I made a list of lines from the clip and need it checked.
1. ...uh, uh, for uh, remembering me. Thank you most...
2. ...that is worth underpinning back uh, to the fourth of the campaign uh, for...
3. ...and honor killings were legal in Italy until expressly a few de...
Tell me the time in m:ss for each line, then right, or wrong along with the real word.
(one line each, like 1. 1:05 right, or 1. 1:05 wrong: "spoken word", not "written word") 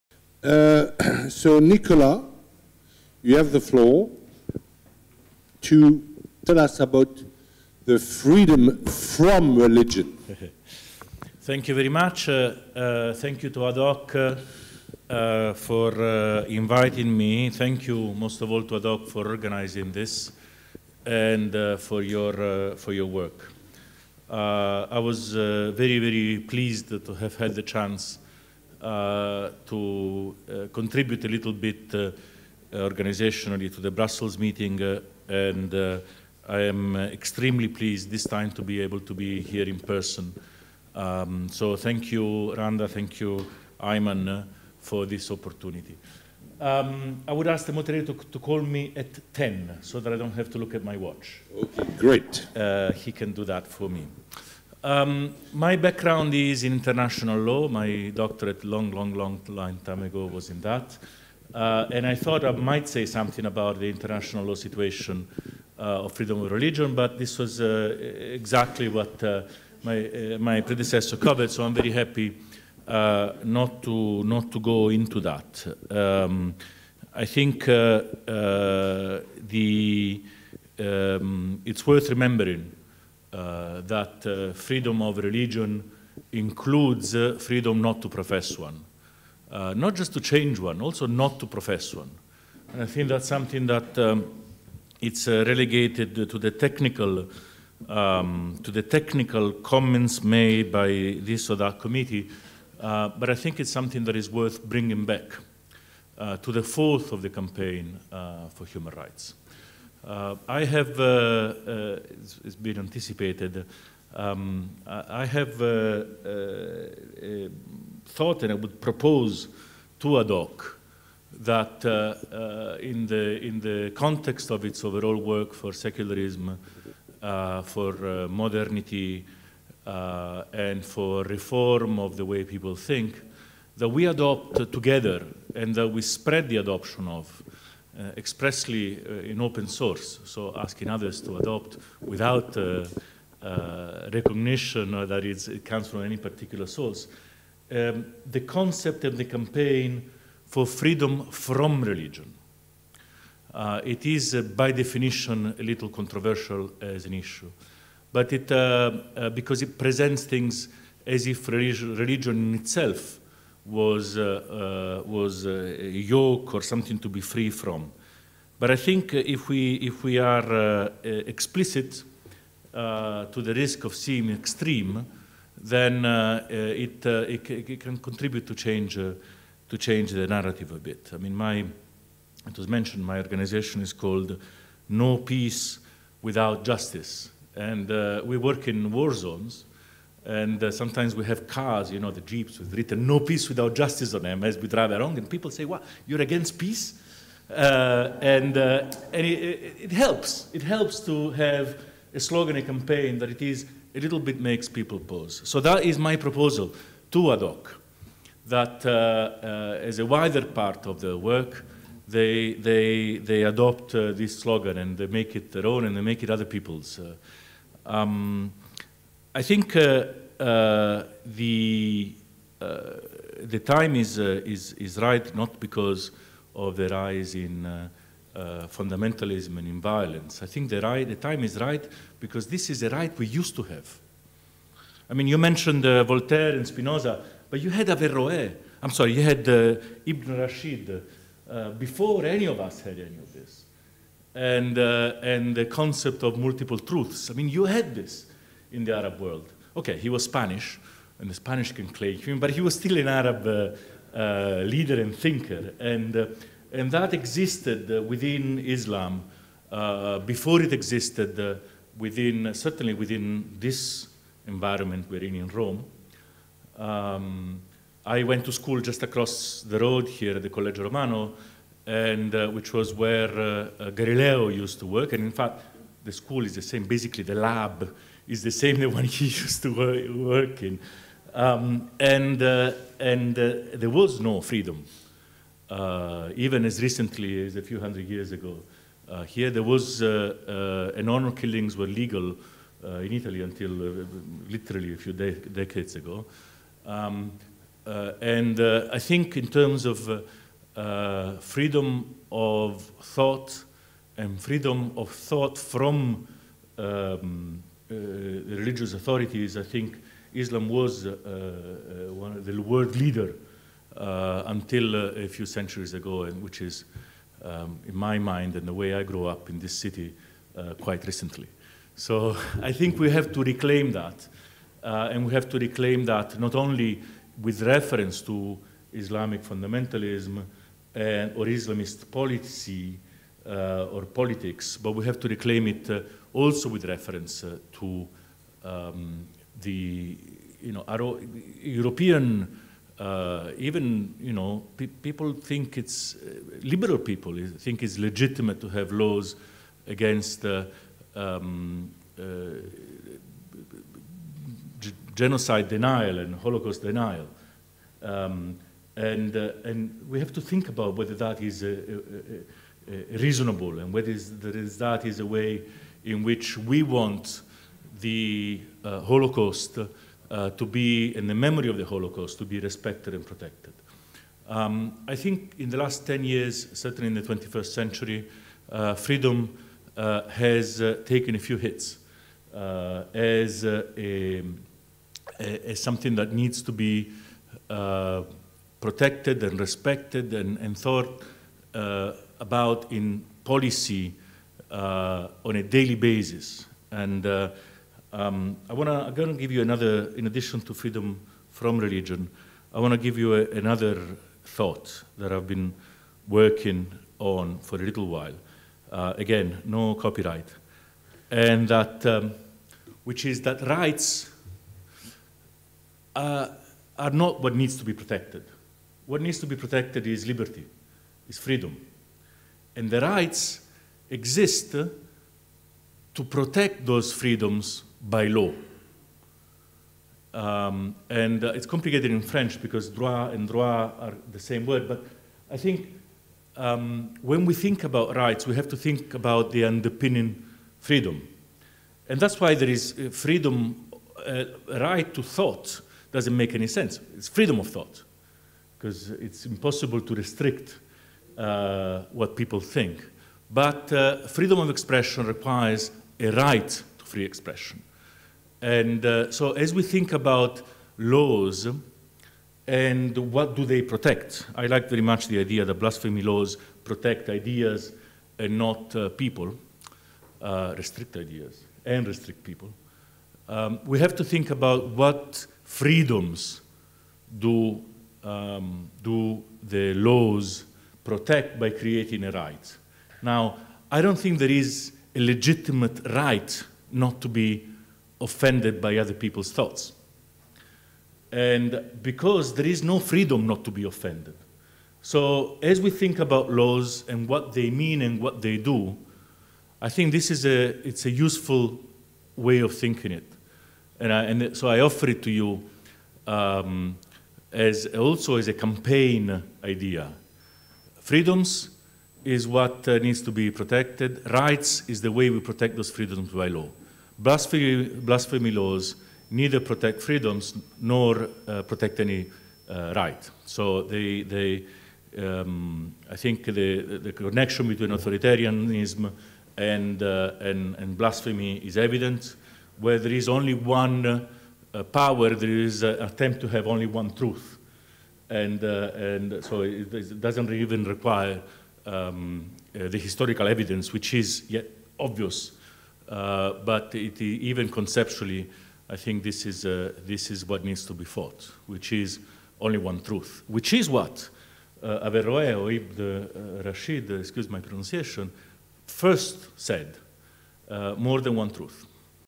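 1. 0:15 wrong: "inviting", not "remembering"
2. 1:44 wrong: "bringing", not "underpinning"
3. 4:50 wrong: "literally", not "expressly".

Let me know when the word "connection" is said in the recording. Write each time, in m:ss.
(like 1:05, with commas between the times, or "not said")
8:47.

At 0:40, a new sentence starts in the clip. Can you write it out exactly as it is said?
Um, so thank you, Randa, thank you, Ayman, for this opportunity.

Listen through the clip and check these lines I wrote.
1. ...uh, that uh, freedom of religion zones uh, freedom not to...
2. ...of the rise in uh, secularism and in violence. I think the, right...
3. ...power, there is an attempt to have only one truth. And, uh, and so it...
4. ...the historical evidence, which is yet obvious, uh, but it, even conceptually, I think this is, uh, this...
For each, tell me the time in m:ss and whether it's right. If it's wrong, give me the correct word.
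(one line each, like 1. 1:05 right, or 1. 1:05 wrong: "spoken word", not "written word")
1. 1:23 wrong: "includes", not "zones"
2. 3:46 wrong: "fundamentalism", not "secularism"
3. 8:54 right
4. 9:02 right.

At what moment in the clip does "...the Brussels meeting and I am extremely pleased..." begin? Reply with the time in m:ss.
0:33.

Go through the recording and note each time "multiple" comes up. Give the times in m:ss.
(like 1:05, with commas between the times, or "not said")
4:06.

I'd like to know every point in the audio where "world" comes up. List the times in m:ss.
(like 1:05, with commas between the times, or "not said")
4:09, 5:12.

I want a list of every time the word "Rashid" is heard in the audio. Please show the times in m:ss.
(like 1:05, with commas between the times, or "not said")
4:00, 9:16.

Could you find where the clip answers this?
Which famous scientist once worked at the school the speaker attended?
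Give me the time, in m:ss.
4:33.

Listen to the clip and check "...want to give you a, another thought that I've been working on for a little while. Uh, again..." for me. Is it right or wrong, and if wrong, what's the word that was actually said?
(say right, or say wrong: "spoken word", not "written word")
right.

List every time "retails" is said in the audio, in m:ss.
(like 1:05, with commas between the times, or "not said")
not said.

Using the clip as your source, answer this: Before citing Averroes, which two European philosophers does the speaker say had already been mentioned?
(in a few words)
Voltaire and Spinoza.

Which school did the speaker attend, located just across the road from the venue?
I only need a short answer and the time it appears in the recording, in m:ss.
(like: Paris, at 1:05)
Collegio Romano, at 4:30.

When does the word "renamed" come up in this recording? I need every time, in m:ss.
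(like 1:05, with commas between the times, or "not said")
not said.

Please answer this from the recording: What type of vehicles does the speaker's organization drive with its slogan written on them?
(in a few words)
Jeeps.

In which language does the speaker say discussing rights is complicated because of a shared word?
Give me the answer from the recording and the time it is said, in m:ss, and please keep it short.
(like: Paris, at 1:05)
French, at 7:12.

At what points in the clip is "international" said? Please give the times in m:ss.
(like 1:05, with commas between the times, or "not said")
0:56, 1:03.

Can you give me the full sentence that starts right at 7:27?
It's freedom of thought because it's impossible to restrict uh, what people think.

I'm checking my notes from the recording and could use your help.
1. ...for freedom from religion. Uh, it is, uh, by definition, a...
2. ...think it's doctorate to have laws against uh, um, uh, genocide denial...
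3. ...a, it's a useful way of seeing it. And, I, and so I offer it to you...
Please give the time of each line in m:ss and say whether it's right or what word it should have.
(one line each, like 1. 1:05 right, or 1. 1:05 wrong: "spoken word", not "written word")
1. 2:30 right
2. 5:47 wrong: "legitimate", not "doctorate"
3. 8:20 wrong: "thinking", not "seeing".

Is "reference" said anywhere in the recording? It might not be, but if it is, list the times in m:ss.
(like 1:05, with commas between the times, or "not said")
5:27, 5:36.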